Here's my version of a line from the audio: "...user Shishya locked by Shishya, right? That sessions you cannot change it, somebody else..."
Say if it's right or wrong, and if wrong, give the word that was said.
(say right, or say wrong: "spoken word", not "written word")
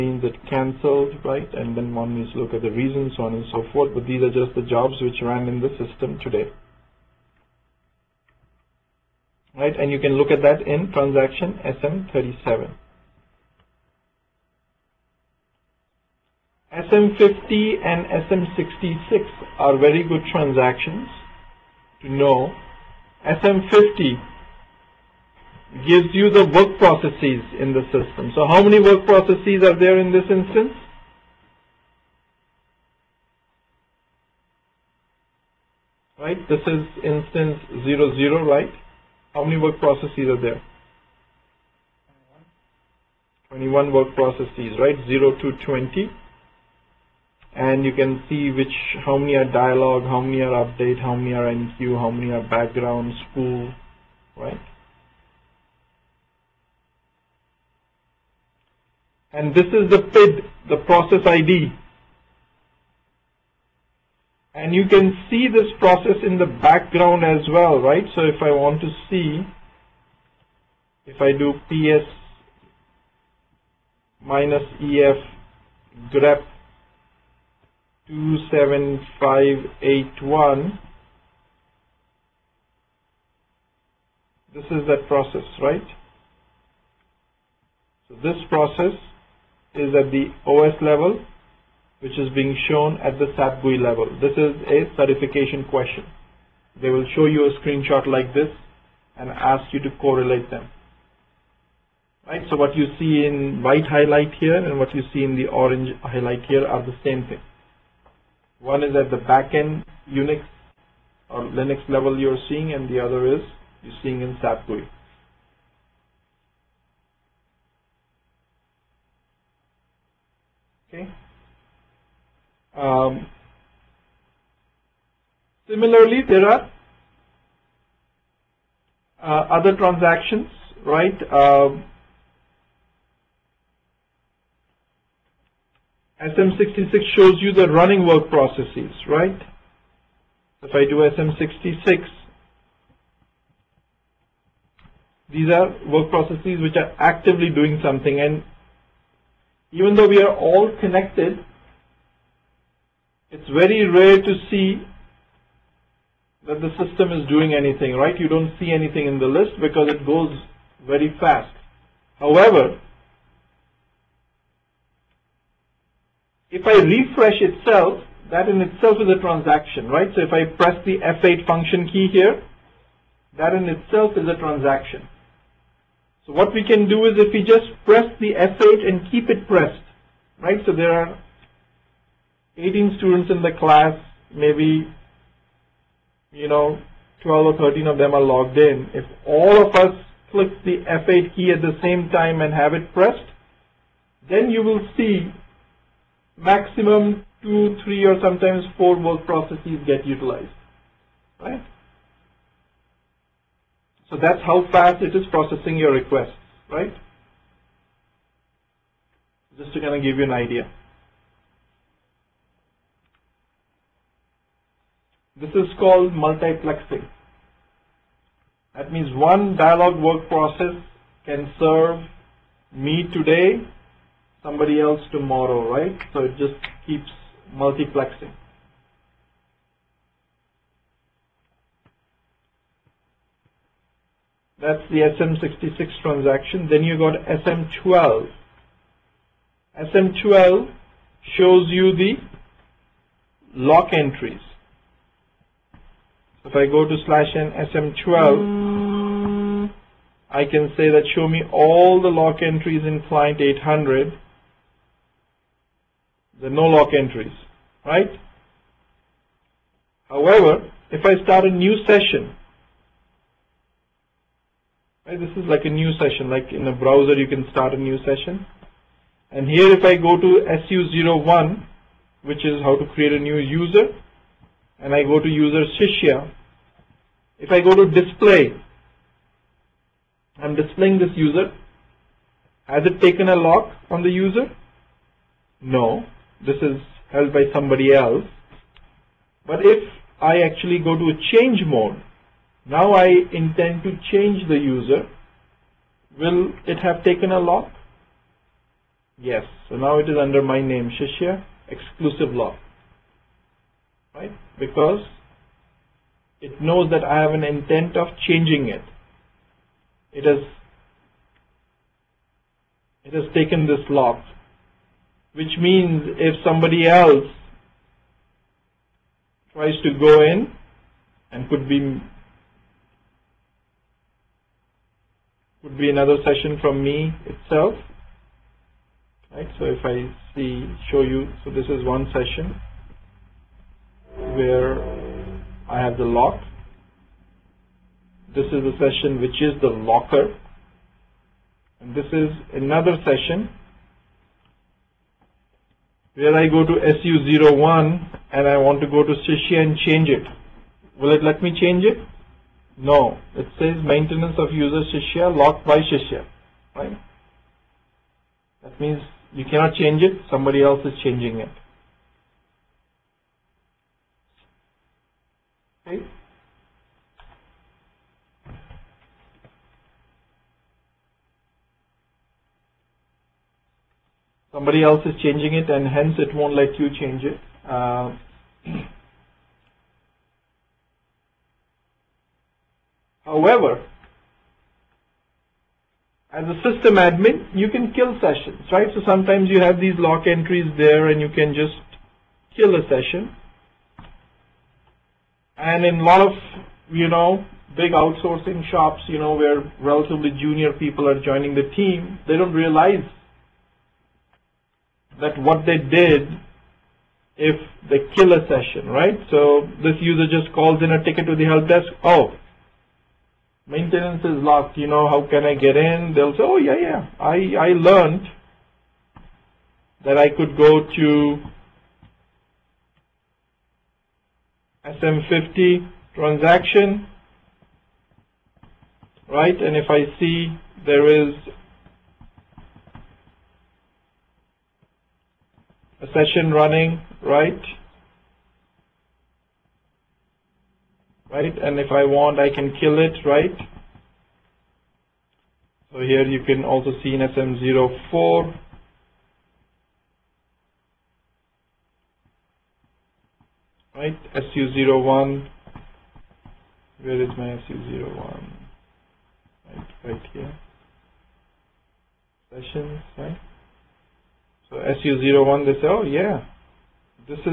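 wrong: "means", not "sessions".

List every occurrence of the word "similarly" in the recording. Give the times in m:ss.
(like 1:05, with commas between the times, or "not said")
2:05.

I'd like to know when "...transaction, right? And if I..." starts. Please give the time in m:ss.
7:06.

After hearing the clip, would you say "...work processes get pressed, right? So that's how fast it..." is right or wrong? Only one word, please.
wrong.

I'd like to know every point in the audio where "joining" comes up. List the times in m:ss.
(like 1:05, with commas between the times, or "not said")
6:41.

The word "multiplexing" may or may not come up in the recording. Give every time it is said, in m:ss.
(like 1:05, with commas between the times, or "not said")
3:36, 3:47.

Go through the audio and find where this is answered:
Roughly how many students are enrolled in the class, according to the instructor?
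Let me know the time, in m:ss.
3:02.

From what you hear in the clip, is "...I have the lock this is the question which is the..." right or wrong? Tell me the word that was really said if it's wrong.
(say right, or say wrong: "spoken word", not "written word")
wrong: "session", not "question".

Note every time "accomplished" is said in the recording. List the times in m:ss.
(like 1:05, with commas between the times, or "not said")
not said.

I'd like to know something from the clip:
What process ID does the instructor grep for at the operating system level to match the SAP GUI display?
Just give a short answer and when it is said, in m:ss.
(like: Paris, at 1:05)
27581, at 1:18.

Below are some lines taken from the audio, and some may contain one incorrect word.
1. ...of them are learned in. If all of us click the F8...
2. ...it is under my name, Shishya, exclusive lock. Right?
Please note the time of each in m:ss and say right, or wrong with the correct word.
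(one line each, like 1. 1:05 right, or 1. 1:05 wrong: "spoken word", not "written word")
1. 3:07 wrong: "logged", not "learned"
2. 4:59 right.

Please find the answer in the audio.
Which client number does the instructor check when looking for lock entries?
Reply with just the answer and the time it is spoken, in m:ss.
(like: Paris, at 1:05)
800, at 4:13.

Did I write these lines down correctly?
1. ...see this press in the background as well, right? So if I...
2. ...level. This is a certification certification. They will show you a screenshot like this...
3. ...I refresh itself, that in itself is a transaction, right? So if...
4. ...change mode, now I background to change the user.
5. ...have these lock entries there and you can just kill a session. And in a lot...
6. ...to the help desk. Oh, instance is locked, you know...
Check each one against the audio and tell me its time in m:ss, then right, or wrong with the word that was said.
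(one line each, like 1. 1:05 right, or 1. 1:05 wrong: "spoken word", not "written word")
1. 1:05 wrong: "process", not "press"
2. 1:33 wrong: "question", not "certification"
3. 2:46 right
4. 4:51 wrong: "intend", not "background"
5. 6:29 right
6. 6:51 wrong: "maintenance", not "instance".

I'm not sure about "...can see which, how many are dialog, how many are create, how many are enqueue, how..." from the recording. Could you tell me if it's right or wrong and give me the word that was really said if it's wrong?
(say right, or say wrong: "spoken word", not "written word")
wrong: "update", not "create".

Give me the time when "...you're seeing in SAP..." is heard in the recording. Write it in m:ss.
1:53.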